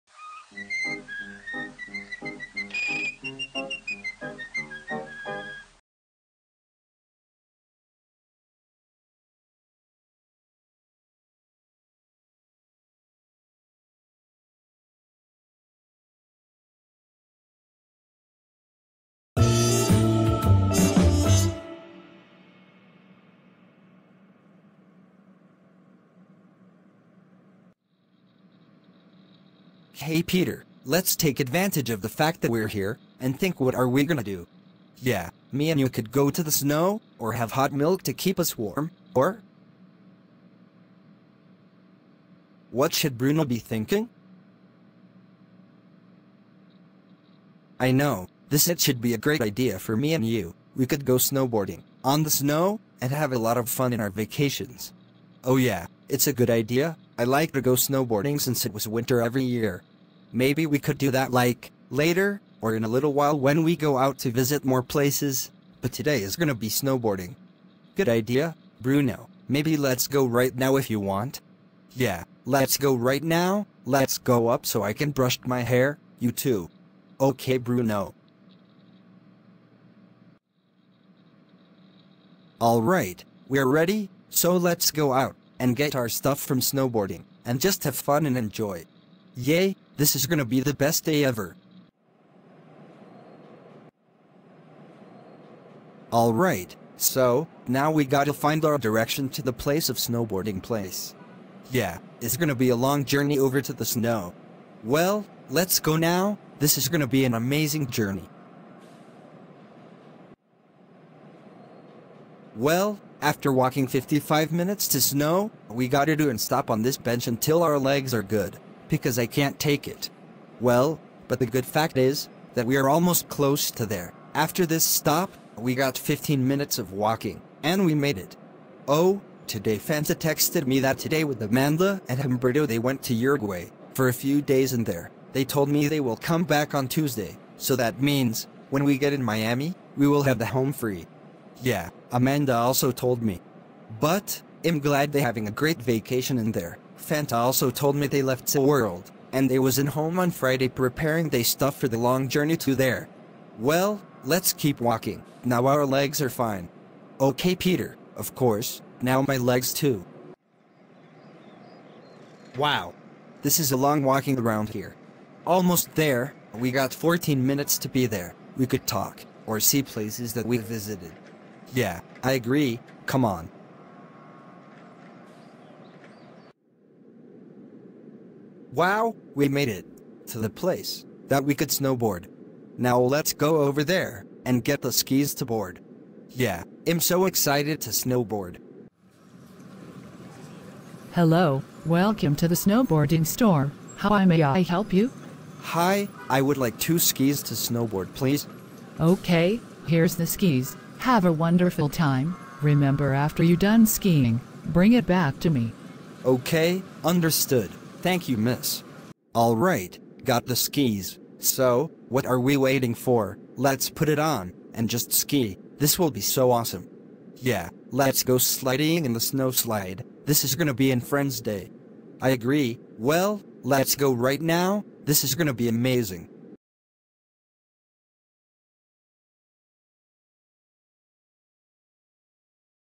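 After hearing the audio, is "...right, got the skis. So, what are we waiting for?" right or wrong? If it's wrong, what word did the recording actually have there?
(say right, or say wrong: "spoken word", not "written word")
right.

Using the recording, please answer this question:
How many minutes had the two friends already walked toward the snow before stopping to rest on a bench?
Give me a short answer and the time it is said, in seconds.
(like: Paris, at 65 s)
55, at 113 s.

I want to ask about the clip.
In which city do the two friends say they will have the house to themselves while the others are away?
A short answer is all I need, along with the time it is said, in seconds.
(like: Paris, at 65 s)
Miami, at 139 s.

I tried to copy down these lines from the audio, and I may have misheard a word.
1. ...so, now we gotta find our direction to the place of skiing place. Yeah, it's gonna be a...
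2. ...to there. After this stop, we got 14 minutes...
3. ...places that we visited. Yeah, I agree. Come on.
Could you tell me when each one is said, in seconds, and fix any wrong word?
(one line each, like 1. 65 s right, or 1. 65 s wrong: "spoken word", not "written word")
1. 96 s wrong: "snowboarding", not "skiing"
2. 123 s wrong: "15", not "14"
3. 169 s right.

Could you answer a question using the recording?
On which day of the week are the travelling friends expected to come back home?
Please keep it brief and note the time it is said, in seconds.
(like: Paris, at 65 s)
Tuesday, at 136 s.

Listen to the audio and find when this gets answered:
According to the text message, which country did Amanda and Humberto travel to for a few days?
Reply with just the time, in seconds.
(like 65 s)
133 s.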